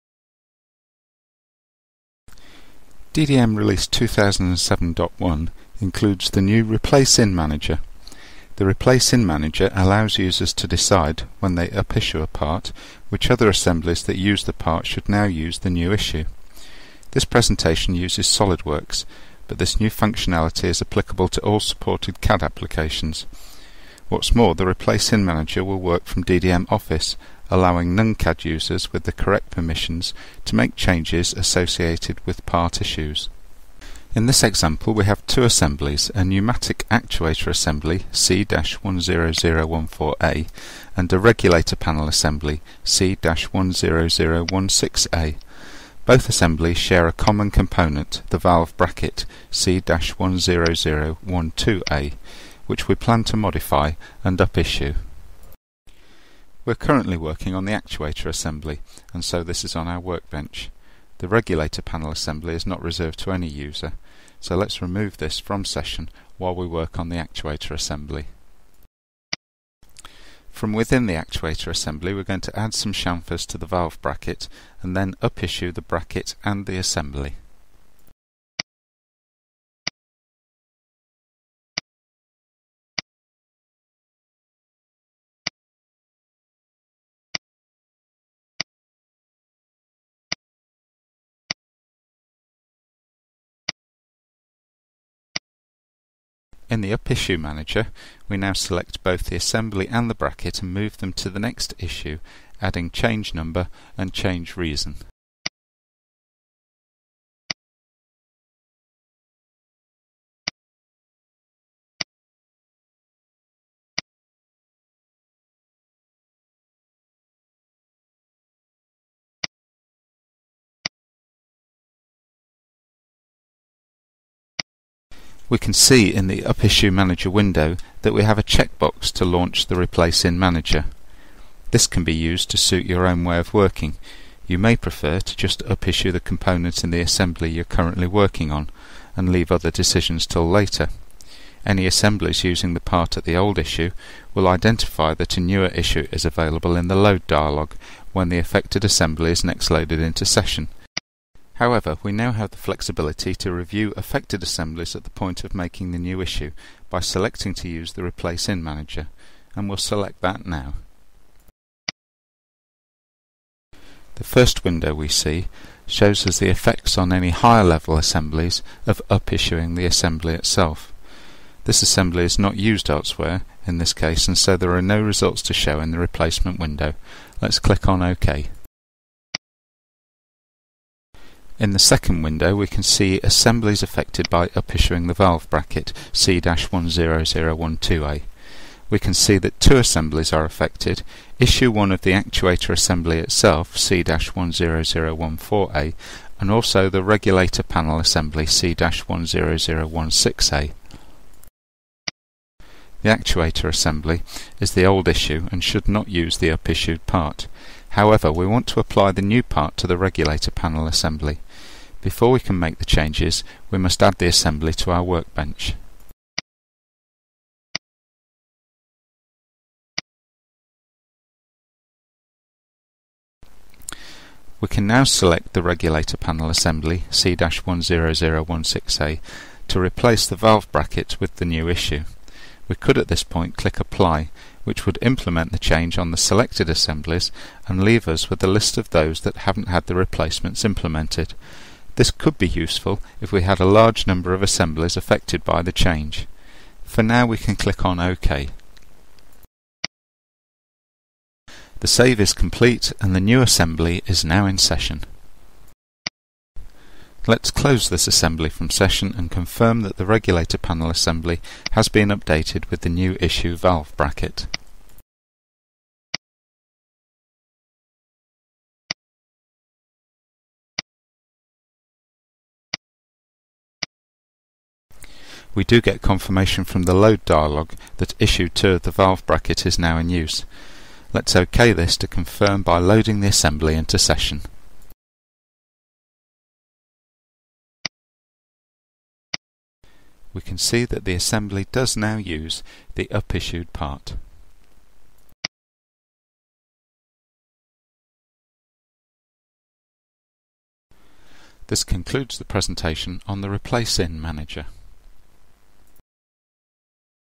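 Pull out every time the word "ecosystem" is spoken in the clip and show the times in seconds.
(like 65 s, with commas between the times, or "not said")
not said.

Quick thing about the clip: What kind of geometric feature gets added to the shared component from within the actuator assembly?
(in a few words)
chamfers.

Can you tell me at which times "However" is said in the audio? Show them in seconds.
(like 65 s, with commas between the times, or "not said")
151 s, 207 s.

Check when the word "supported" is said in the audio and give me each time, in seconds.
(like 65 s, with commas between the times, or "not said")
21 s.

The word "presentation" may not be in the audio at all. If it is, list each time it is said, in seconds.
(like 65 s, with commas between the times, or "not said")
17 s, 302 s.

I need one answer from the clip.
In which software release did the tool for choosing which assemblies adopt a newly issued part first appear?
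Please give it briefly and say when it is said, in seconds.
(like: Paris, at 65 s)
2007.1, at 3 s.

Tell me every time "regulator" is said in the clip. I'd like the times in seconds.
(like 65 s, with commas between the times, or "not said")
41 s, 61 s, 197 s, 209 s, 225 s, 260 s.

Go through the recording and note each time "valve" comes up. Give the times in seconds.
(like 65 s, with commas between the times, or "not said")
48 s, 73 s, 185 s, 230 s, 263 s, 278 s.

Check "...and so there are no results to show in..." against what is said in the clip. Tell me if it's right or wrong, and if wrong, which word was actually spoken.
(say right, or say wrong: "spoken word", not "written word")
right.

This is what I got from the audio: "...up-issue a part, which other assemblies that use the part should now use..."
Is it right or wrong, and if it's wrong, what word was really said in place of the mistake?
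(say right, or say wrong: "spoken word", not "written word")
right.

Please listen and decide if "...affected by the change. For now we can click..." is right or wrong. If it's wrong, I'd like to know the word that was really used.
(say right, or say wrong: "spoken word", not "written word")
right.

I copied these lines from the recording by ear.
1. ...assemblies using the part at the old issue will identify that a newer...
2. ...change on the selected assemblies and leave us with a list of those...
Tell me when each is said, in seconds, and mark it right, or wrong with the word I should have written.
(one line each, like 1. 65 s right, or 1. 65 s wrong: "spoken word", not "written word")
1. 141 s right
2. 235 s right.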